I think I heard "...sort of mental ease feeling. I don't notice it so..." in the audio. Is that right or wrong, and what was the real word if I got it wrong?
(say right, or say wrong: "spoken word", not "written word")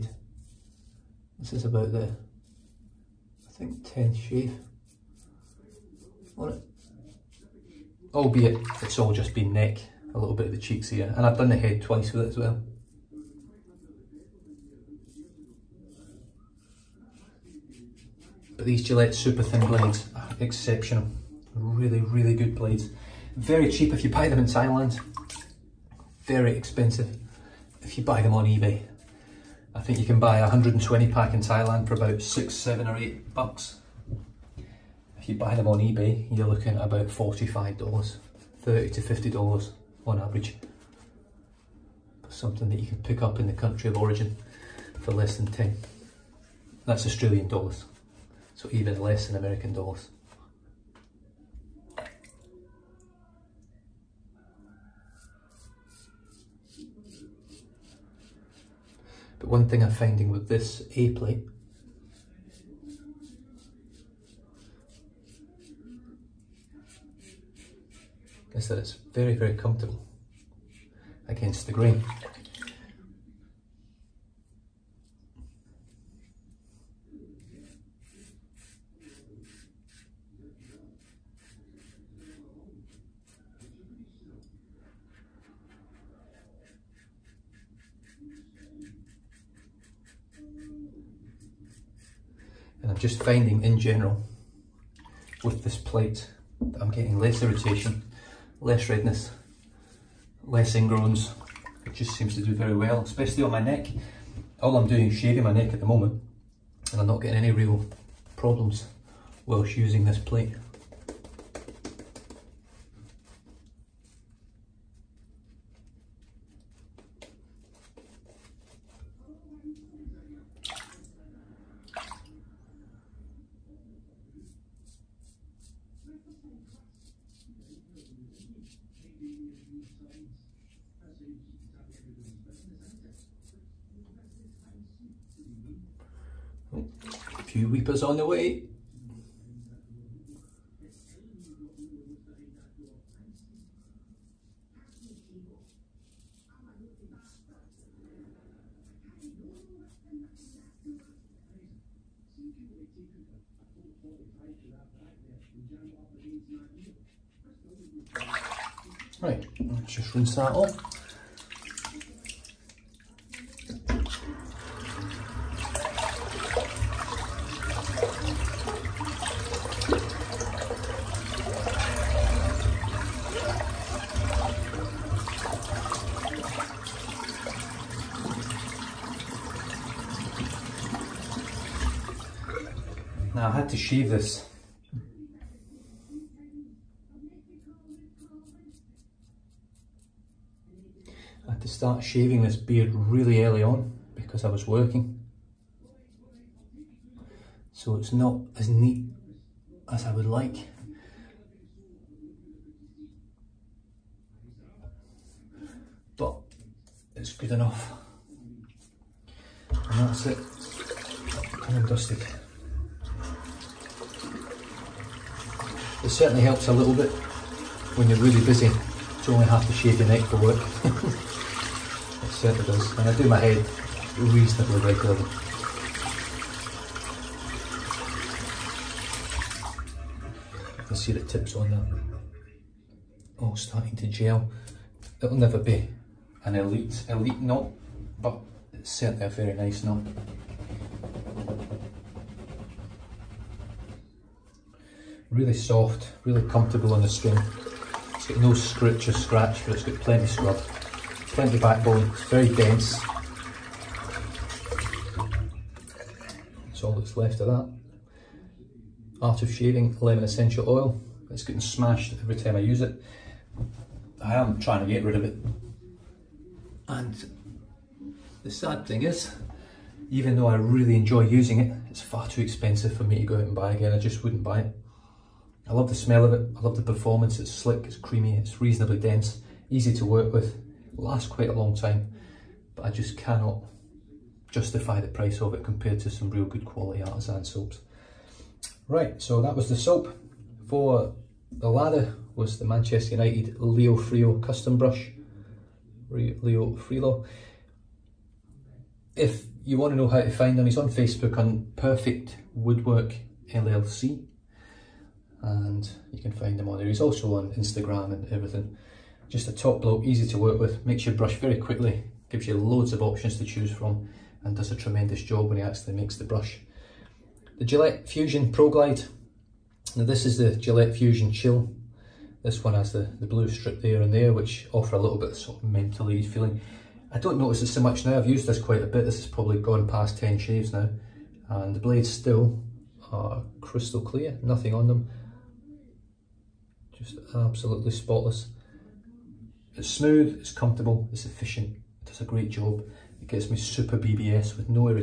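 right.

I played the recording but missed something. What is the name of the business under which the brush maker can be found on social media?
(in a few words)
Perfect Woodwork LLC.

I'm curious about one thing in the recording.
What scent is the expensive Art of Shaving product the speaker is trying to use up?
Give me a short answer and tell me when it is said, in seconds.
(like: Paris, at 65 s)
Lemon, at 259 s.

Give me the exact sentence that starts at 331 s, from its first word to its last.
And the blades still are crystal clear, nothing on them.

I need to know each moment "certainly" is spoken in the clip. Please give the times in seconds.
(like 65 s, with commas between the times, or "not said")
216 s, 222 s, 238 s.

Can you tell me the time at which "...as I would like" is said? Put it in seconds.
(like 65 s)
199 s.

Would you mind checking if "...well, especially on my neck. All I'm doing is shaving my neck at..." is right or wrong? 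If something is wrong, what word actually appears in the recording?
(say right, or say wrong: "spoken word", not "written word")
right.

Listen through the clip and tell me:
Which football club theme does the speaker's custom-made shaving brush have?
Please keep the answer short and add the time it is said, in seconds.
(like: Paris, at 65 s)
Manchester United, at 292 s.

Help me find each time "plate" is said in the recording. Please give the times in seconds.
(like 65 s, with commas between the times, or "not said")
61 s, 95 s, 110 s.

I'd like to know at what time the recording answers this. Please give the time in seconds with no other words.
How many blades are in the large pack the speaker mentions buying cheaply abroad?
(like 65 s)
30 s.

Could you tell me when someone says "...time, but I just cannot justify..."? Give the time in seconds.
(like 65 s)
281 s.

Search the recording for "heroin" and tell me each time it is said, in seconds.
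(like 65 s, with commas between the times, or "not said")
not said.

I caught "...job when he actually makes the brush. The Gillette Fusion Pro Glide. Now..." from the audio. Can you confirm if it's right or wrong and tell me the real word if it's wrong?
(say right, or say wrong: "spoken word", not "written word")
right.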